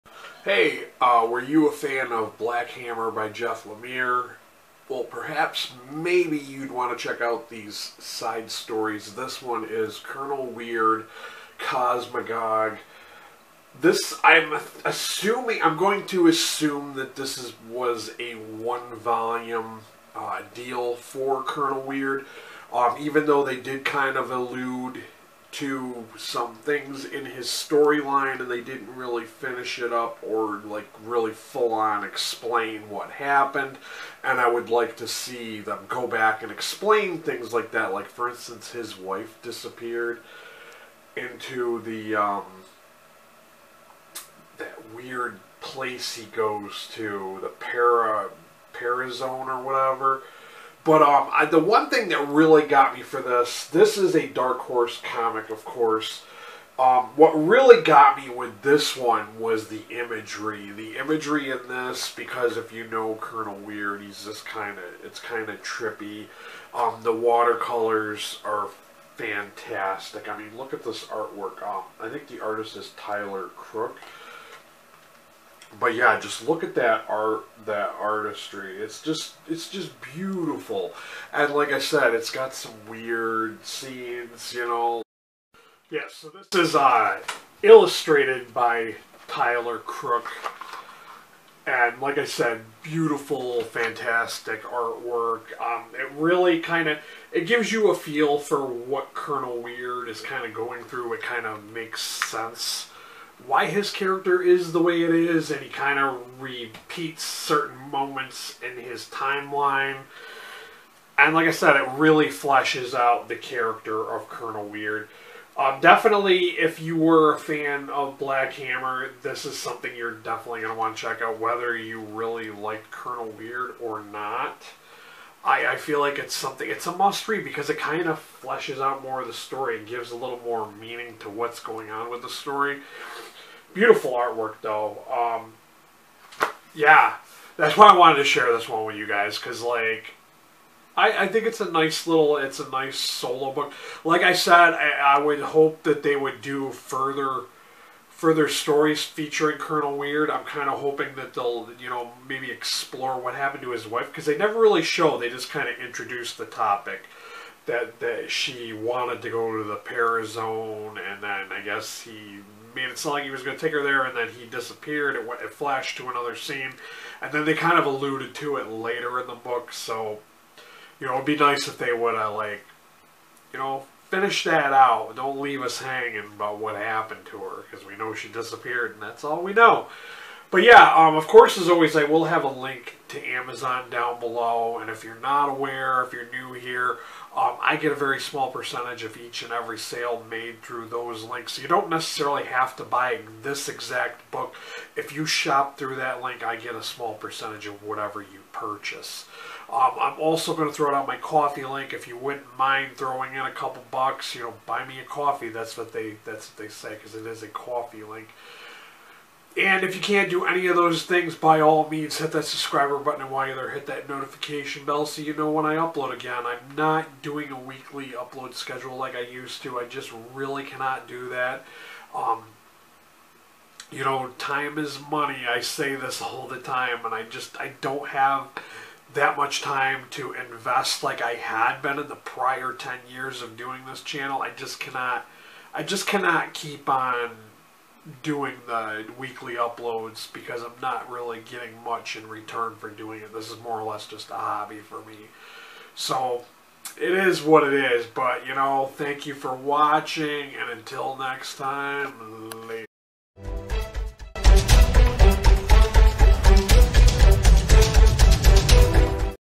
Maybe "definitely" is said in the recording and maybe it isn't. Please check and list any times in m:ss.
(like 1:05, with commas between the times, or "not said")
1:55, 2:00.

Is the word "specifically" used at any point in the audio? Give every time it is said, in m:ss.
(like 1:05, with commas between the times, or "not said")
not said.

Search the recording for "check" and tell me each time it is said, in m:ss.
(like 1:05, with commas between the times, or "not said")
0:07, 2:01.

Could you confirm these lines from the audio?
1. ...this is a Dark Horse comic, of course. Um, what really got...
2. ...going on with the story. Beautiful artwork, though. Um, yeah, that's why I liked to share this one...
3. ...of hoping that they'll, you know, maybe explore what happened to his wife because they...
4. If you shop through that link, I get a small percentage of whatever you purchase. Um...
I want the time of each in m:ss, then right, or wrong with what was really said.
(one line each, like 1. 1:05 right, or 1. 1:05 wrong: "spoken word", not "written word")
1. 0:53 right
2. 2:11 wrong: "wanted", not "liked"
3. 2:30 right
4. 3:14 right.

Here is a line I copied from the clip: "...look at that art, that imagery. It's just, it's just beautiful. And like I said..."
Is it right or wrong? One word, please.
wrong.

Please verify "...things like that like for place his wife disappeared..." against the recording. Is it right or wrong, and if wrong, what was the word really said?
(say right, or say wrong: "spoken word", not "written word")
wrong: "instance", not "place".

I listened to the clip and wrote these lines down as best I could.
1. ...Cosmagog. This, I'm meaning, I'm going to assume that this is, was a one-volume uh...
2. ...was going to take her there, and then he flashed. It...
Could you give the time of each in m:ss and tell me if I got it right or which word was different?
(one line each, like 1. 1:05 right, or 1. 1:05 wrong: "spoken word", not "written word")
1. 0:11 wrong: "assuming", not "meaning"
2. 2:43 wrong: "disappeared", not "flashed".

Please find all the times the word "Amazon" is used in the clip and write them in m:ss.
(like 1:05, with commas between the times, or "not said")
3:03.